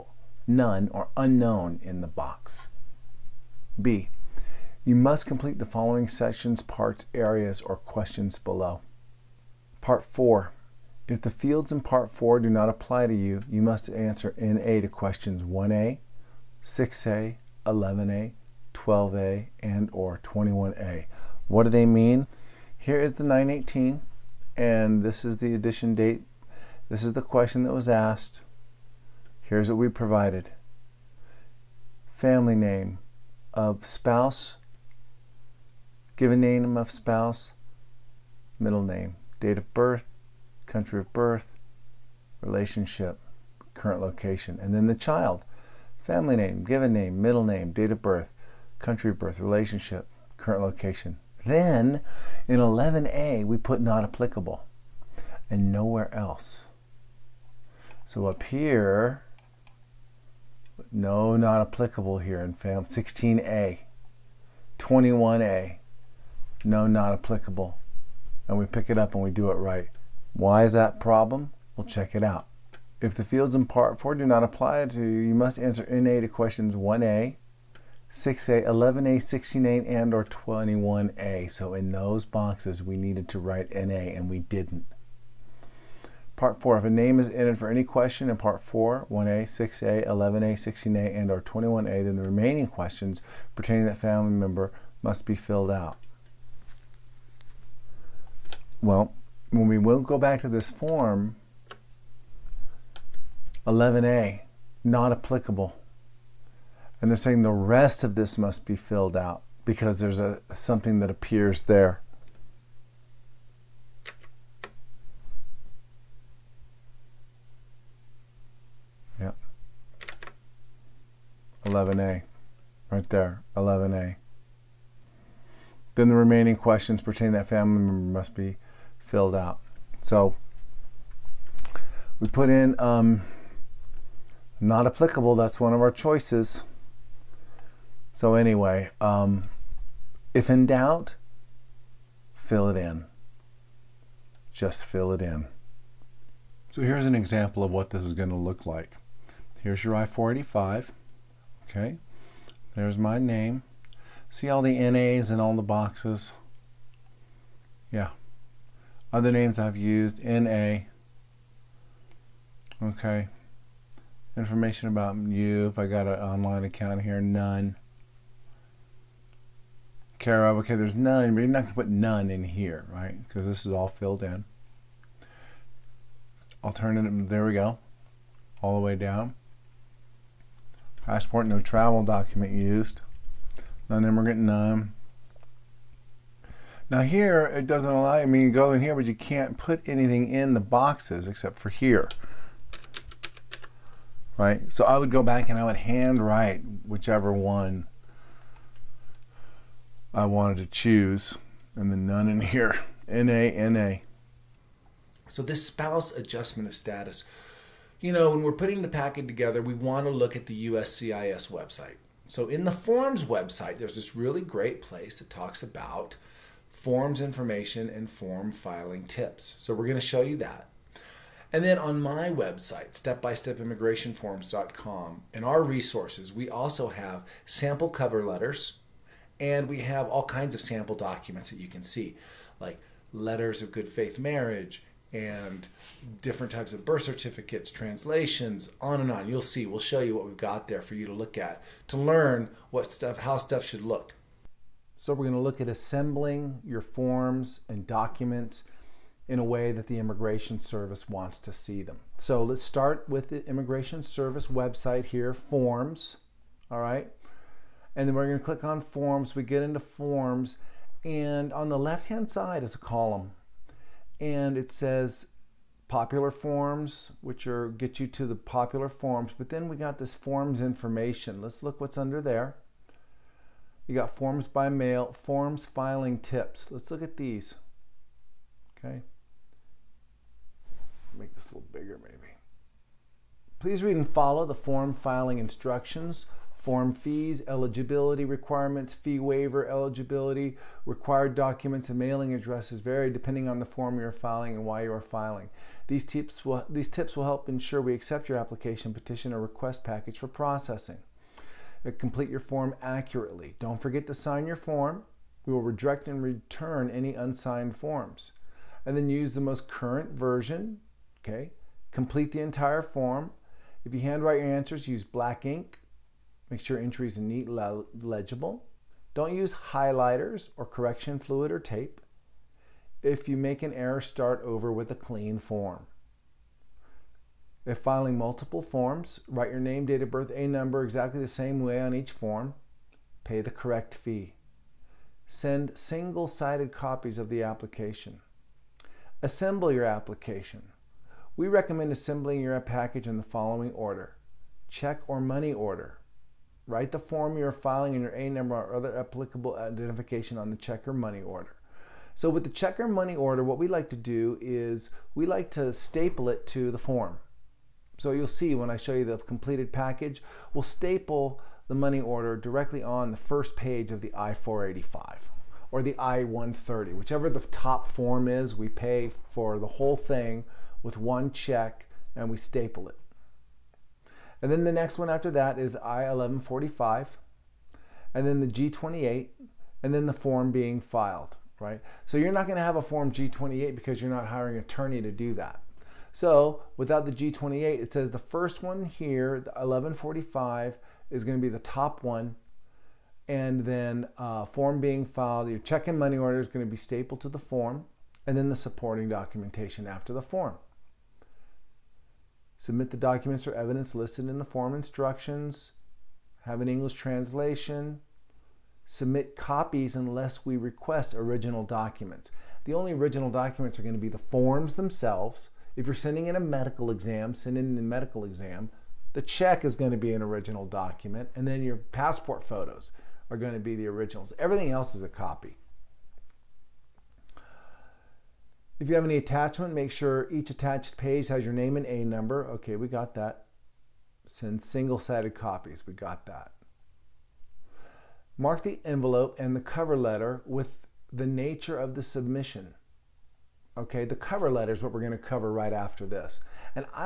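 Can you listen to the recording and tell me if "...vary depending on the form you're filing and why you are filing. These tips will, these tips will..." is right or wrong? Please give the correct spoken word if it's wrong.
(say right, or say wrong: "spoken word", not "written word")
right.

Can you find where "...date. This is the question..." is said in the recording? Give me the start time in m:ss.
0:25.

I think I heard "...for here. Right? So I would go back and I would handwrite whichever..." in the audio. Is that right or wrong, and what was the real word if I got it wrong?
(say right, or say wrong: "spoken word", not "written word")
right.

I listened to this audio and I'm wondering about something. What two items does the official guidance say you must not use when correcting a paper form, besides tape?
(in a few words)
highlighters or correction fluid.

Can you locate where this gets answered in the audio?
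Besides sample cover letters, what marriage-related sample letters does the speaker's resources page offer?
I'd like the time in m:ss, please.
3:53.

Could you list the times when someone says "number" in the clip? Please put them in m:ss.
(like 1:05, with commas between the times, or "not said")
5:30, 5:48, 7:12.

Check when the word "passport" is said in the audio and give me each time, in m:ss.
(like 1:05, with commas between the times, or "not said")
3:01, 7:01.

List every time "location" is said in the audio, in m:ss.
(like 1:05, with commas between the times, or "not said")
0:44, 0:50.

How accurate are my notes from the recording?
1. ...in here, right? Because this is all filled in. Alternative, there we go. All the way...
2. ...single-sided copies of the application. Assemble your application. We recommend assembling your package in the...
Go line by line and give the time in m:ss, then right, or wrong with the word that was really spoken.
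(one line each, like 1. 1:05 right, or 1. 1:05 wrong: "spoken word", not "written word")
1. 2:52 right
2. 5:35 right.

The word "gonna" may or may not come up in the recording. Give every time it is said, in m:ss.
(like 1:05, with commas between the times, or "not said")
4:18, 6:22.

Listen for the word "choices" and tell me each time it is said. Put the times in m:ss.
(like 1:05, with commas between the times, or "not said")
2:15.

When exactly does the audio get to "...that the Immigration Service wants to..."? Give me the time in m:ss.
4:09.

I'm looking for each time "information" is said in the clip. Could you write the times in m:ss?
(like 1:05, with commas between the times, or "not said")
2:44, 3:37, 4:30.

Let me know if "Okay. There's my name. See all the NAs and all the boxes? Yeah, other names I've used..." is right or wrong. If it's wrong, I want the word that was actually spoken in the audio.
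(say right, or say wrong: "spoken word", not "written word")
right.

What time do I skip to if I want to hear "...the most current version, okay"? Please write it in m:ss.
5:09.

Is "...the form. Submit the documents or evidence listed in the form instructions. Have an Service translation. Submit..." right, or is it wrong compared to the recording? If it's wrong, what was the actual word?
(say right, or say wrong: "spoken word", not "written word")
wrong: "English", not "Service".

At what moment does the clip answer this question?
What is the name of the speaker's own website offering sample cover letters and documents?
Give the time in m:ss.
3:42.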